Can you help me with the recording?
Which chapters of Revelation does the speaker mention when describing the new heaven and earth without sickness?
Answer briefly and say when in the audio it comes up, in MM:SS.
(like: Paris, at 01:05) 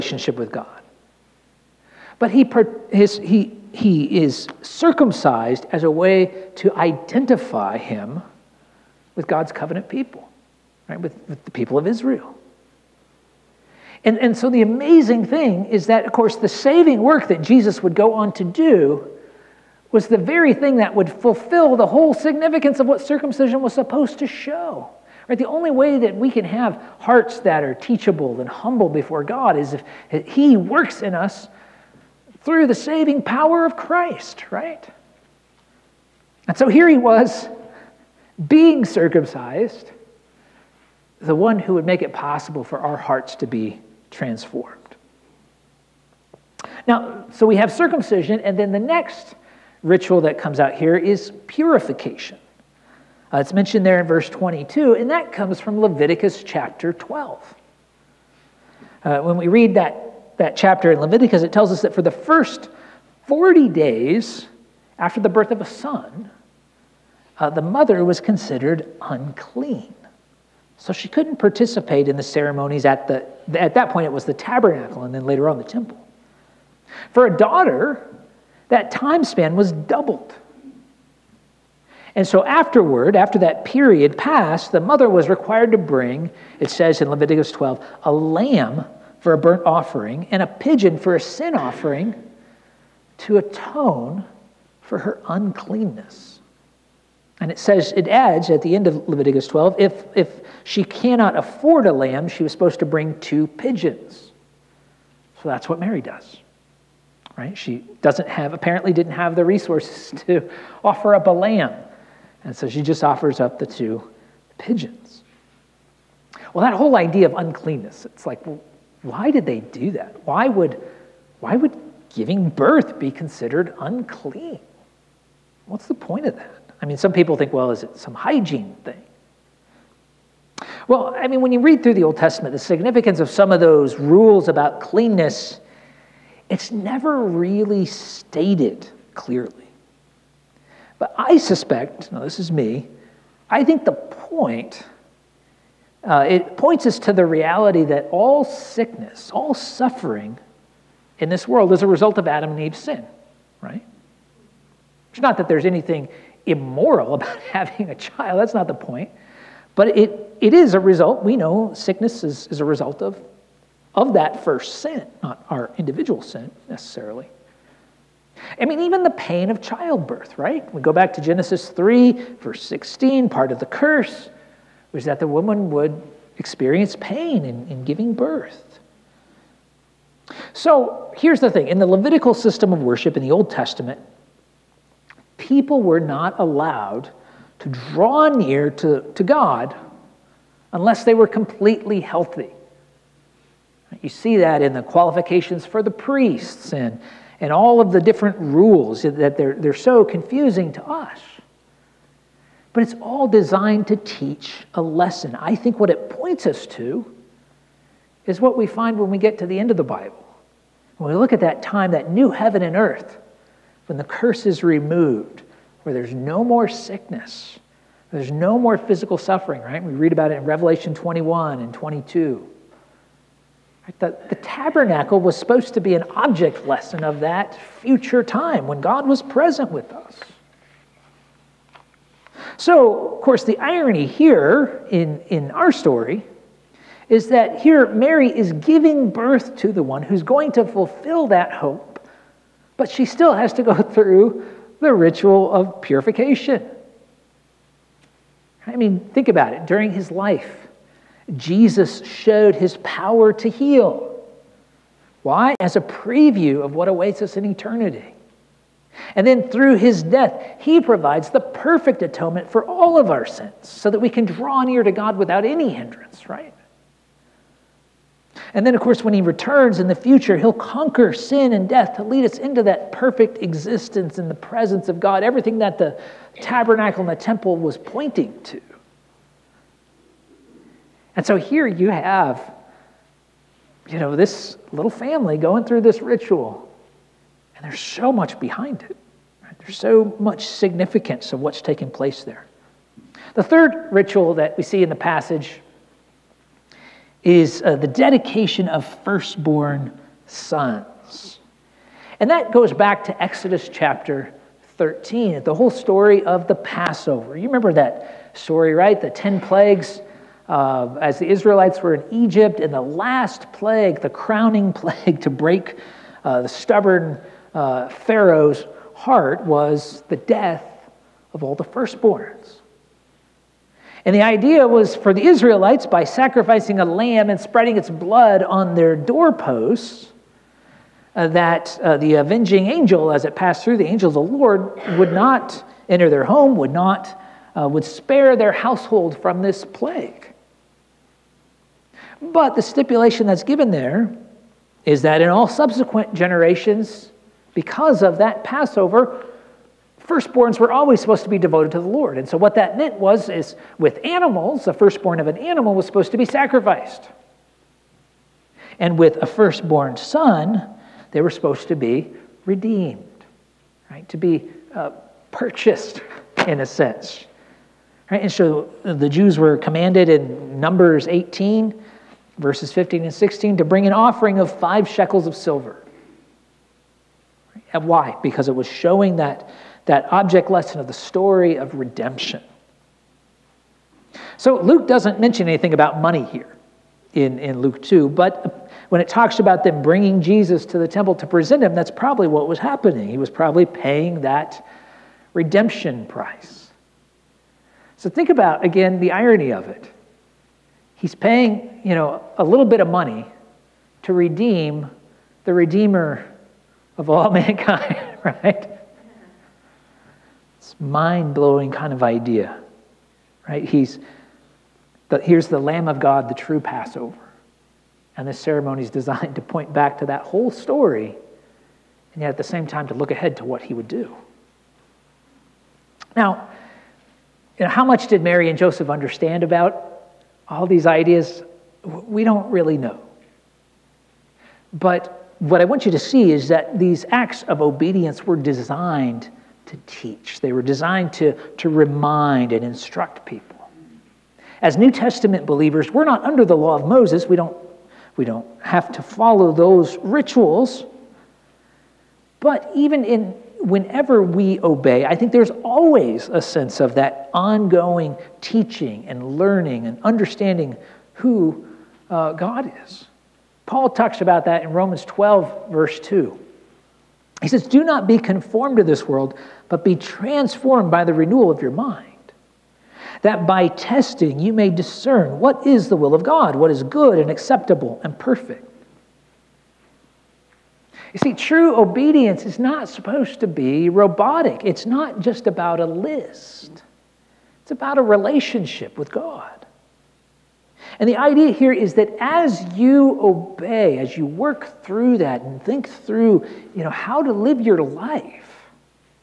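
Revelation 21 and 22, at 03:40.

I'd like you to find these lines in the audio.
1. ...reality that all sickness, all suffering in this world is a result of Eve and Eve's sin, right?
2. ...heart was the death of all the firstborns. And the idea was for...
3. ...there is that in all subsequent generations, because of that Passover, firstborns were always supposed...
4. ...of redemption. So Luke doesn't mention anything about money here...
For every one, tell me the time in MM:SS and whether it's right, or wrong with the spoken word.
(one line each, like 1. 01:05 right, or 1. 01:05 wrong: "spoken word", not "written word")
1. 02:27 wrong: "Adam", not "Eve"
2. 05:18 right
3. 05:43 right
4. 06:21 right.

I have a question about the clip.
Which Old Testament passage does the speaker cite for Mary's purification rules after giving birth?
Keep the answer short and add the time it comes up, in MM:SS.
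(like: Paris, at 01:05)
Leviticus 12, at 00:55.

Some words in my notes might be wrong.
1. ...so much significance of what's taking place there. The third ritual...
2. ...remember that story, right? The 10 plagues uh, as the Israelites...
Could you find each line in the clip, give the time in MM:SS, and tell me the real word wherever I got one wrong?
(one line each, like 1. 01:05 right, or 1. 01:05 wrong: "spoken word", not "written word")
1. 04:49 right
2. 05:07 right.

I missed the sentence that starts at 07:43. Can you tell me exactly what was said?
Paul talks about that in Romans 12, verse 2.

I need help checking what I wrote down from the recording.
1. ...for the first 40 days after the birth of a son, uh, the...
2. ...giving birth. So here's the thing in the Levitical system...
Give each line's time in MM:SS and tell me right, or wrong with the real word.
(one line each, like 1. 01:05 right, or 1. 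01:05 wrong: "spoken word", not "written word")
1. 01:01 right
2. 02:57 right.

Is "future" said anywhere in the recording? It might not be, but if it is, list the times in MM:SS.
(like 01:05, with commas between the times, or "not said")
03:47, 04:29.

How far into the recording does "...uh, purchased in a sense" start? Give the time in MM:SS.
06:04.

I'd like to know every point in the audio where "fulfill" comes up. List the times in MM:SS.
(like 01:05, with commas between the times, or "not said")
00:21, 04:00.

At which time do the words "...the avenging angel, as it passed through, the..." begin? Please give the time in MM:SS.
05:31.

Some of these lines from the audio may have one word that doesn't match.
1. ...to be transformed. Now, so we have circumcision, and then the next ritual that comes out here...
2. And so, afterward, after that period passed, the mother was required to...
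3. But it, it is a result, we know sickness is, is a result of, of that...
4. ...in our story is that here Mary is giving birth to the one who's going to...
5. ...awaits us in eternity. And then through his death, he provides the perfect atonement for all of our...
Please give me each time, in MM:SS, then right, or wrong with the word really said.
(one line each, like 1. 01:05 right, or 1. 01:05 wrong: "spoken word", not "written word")
1. 00:43 right
2. 01:22 right
3. 02:39 right
4. 03:55 right
5. 04:16 right.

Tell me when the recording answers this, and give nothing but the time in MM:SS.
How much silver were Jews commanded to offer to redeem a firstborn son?
06:14.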